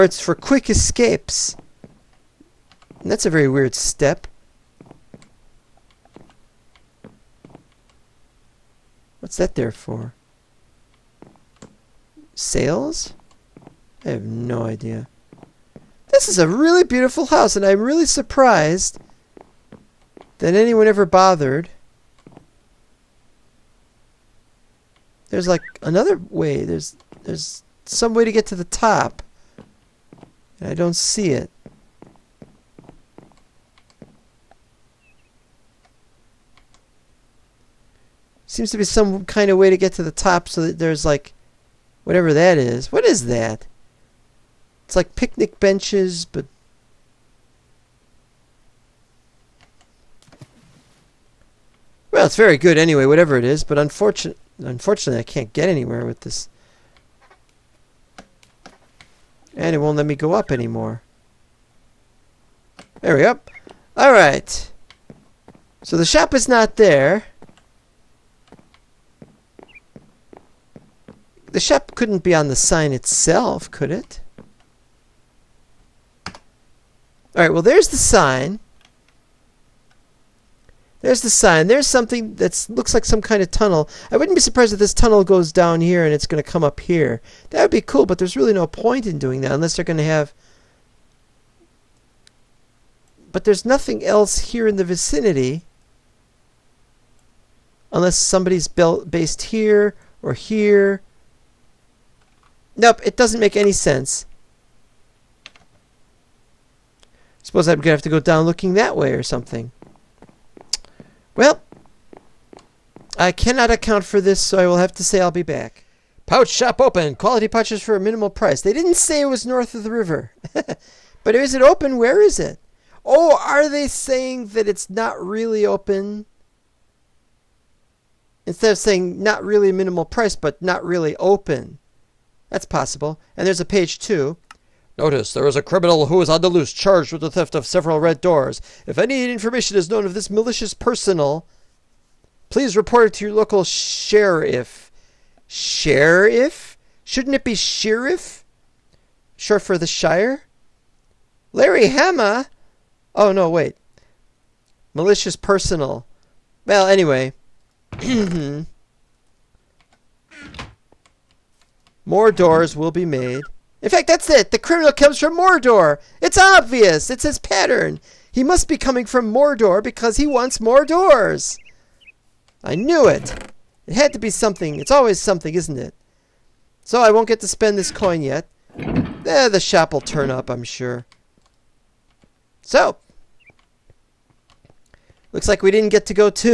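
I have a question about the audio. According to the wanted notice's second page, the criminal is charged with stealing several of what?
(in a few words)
Red doors.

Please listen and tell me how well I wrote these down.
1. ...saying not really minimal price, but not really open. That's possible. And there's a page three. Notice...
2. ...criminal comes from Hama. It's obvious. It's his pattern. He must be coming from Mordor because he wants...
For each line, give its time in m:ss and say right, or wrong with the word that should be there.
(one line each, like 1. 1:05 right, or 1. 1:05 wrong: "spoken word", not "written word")
1. 2:08 wrong: "two", not "three"
2. 2:44 wrong: "Mordor", not "Hama".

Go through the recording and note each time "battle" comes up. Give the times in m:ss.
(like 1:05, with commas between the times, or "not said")
not said.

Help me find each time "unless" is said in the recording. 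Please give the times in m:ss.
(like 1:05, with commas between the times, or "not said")
1:29, 1:37.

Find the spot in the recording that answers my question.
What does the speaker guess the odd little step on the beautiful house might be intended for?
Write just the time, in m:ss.
0:00.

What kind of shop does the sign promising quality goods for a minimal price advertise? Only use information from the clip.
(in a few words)
Pouch shop.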